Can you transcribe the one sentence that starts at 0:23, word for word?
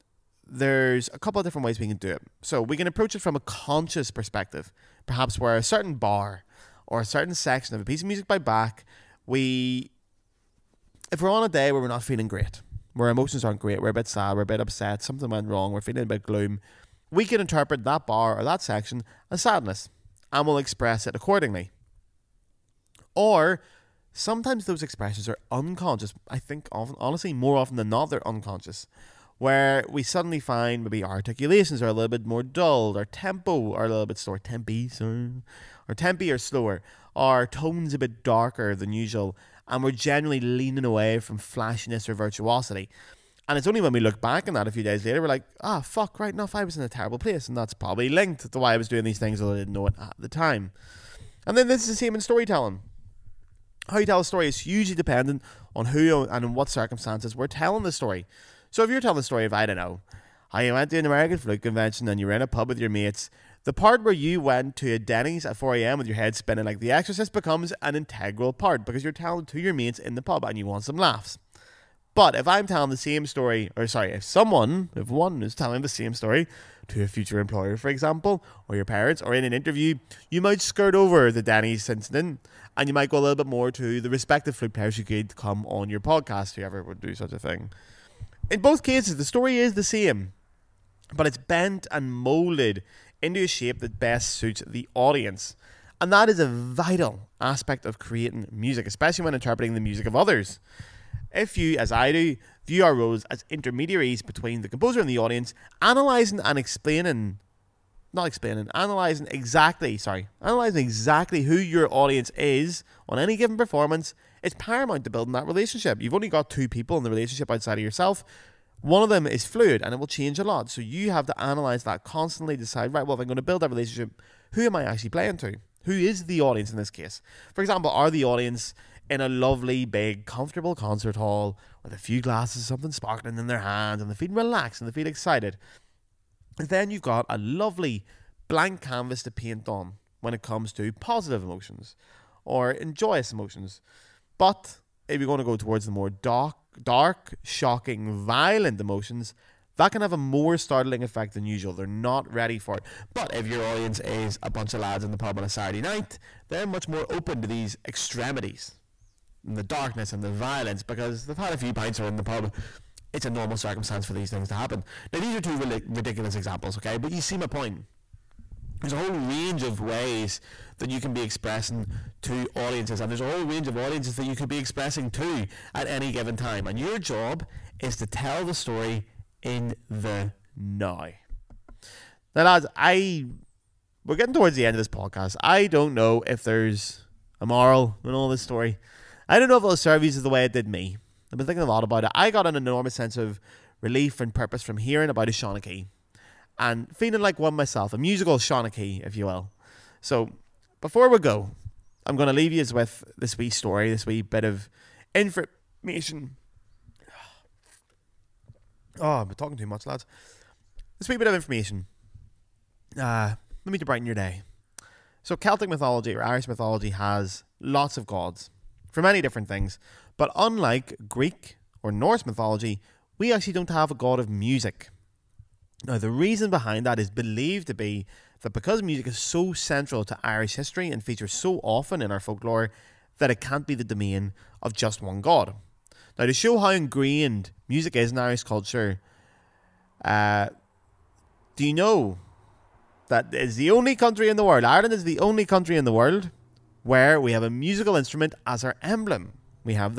Or sometimes those expressions are unconscious.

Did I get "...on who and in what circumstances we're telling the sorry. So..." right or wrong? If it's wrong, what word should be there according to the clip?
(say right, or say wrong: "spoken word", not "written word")
wrong: "story", not "sorry".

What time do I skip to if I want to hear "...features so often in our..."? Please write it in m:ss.
3:51.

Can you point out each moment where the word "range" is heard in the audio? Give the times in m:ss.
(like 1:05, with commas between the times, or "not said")
2:49, 2:53.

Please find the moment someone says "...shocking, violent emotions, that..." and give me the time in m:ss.
2:27.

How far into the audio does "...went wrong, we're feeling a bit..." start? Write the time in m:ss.
0:15.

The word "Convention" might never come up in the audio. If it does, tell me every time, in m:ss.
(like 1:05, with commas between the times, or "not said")
1:01.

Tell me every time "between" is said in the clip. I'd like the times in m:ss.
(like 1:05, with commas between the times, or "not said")
1:44.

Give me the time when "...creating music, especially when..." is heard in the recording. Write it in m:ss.
1:37.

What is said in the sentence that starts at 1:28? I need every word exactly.
In both cases, the story is the same, but it's bent and molded into a shape that best suits the audience.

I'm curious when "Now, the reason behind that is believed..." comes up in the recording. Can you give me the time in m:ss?
3:45.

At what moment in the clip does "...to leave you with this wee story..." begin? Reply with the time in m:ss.
3:22.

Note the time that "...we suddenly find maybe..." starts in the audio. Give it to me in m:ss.
0:29.